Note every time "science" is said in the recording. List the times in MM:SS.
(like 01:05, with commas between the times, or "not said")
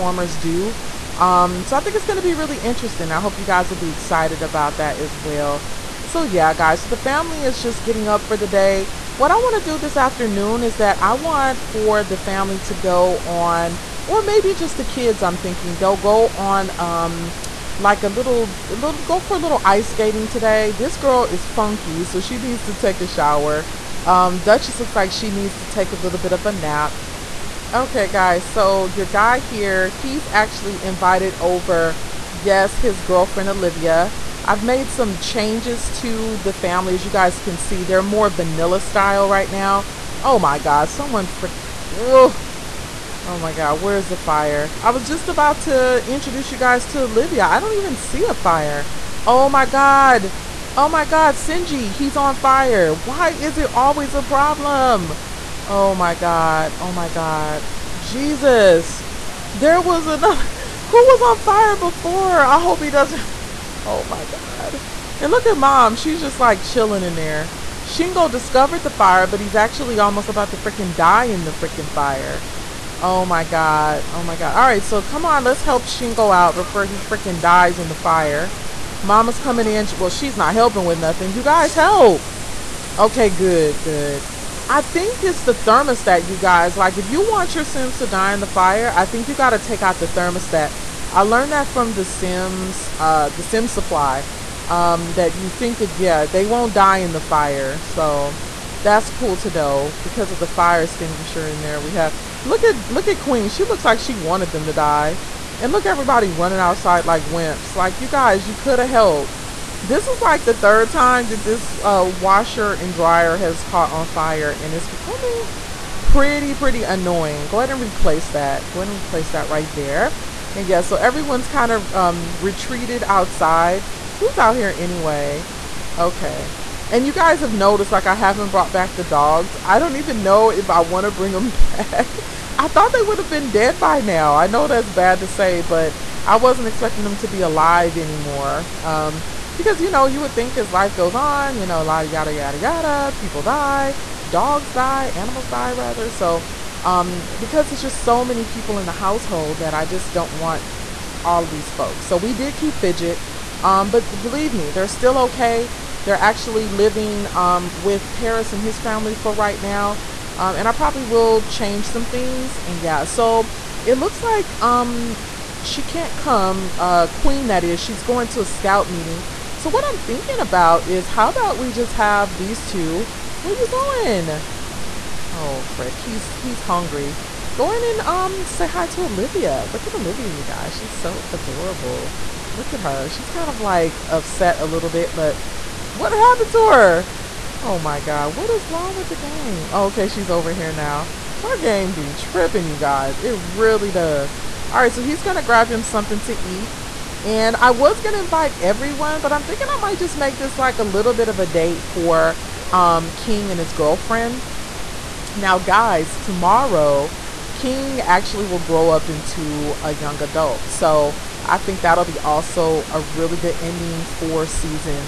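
not said.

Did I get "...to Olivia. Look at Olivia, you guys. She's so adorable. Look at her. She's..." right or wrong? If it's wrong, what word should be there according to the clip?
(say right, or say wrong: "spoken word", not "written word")
right.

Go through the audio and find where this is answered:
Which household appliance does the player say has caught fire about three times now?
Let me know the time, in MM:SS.
01:52.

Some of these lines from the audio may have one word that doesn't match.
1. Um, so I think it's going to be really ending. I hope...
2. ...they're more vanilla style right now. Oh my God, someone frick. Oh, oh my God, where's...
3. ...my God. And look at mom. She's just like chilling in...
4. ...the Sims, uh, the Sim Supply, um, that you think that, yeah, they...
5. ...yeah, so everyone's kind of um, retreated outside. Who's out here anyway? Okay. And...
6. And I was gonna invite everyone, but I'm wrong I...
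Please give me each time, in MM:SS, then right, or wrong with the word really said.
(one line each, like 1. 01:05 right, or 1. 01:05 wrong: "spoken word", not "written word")
1. 00:01 wrong: "interesting", not "ending"
2. 00:37 right
3. 01:04 right
4. 01:31 right
5. 02:00 right
6. 03:17 wrong: "thinking", not "wrong".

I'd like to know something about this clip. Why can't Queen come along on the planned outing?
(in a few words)
scout meeting.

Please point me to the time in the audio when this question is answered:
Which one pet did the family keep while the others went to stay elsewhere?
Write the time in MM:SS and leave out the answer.
02:32.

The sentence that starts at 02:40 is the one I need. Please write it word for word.
Um, and I probably will change some things.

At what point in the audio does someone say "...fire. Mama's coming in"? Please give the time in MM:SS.
01:17.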